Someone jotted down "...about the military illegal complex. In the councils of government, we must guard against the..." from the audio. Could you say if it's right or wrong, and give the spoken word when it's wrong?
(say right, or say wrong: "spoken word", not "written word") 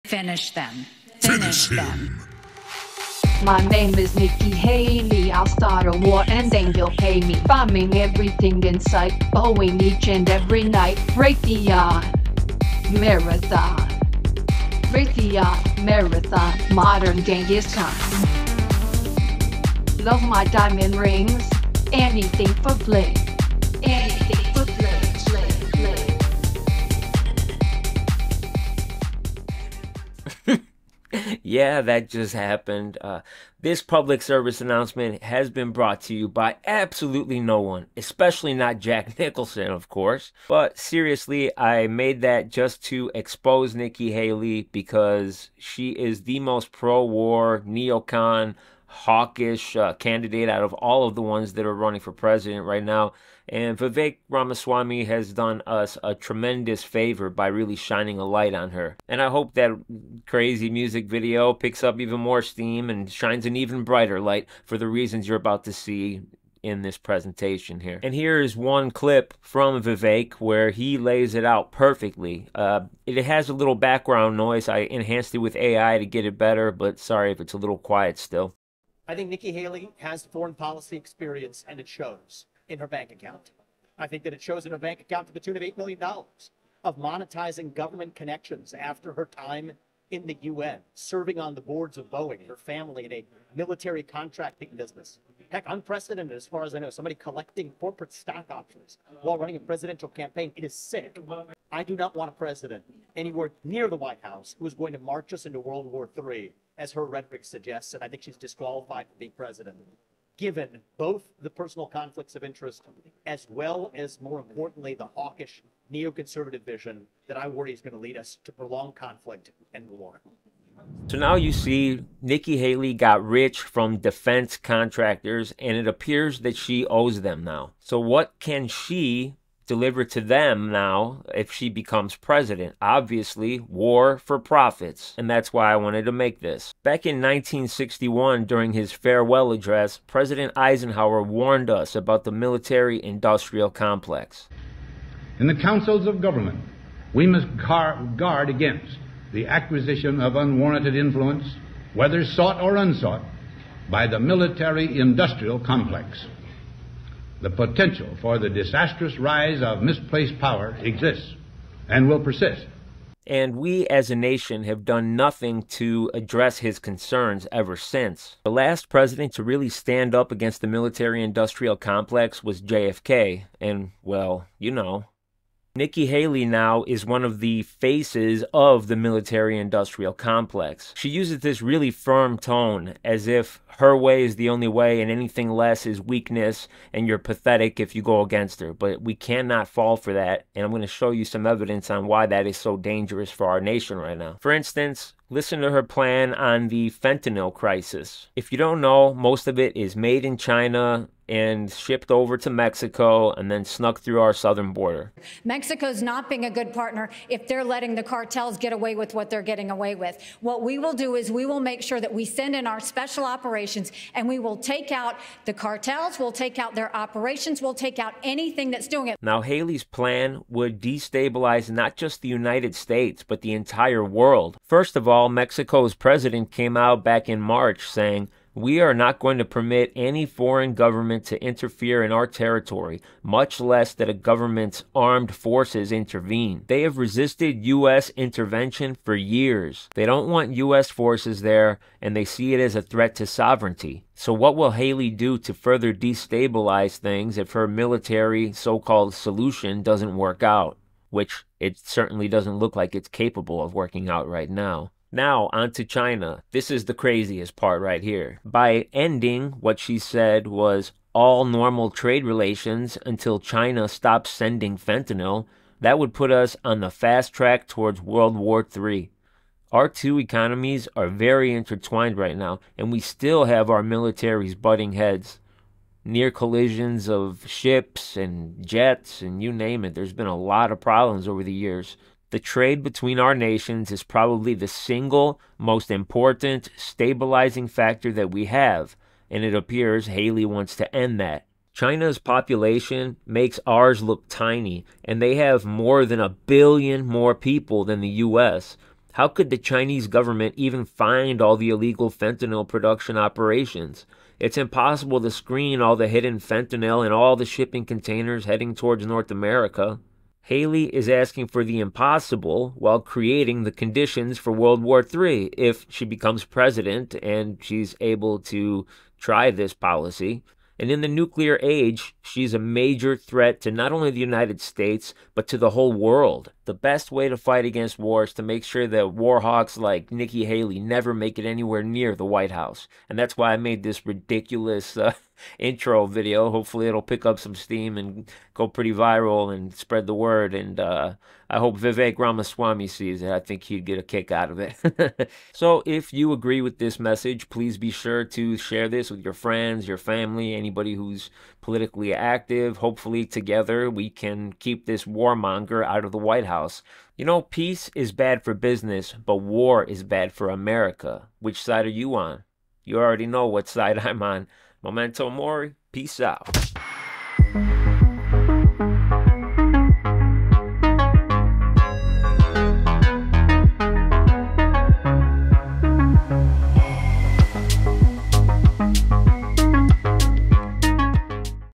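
wrong: "industrial", not "illegal".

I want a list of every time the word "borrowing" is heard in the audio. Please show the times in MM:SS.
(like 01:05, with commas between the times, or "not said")
not said.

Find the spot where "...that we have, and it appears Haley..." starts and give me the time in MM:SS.
04:48.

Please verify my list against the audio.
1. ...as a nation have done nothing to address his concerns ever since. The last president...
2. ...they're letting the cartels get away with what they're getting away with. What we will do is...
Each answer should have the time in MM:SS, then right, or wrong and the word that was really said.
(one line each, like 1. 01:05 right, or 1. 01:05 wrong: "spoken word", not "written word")
1. 02:43 right
2. 03:27 right.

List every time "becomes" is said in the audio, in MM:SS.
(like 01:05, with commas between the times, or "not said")
02:11, 05:16.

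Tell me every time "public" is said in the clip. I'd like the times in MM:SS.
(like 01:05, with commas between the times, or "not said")
00:33.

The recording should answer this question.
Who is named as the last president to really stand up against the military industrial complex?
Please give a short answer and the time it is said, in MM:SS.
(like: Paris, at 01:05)
JFK, at 02:52.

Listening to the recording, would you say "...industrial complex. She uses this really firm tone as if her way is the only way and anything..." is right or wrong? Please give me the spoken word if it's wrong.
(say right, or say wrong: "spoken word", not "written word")
right.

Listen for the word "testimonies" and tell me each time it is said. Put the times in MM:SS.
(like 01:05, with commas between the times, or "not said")
not said.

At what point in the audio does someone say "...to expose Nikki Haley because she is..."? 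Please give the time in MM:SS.
00:42.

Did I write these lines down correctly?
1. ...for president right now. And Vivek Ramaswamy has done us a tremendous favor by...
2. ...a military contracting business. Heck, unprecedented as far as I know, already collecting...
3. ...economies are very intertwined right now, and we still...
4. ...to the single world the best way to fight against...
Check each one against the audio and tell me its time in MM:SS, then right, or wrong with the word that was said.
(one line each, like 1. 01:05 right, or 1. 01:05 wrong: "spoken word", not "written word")
1. 00:52 right
2. 01:33 wrong: "somebody", not "already"
3. 04:30 right
4. 05:25 wrong: "whole", not "single".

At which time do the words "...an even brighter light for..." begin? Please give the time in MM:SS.
01:03.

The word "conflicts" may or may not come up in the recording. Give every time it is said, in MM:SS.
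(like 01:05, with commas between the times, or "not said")
01:51, 01:58.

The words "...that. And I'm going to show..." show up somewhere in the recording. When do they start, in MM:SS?
03:10.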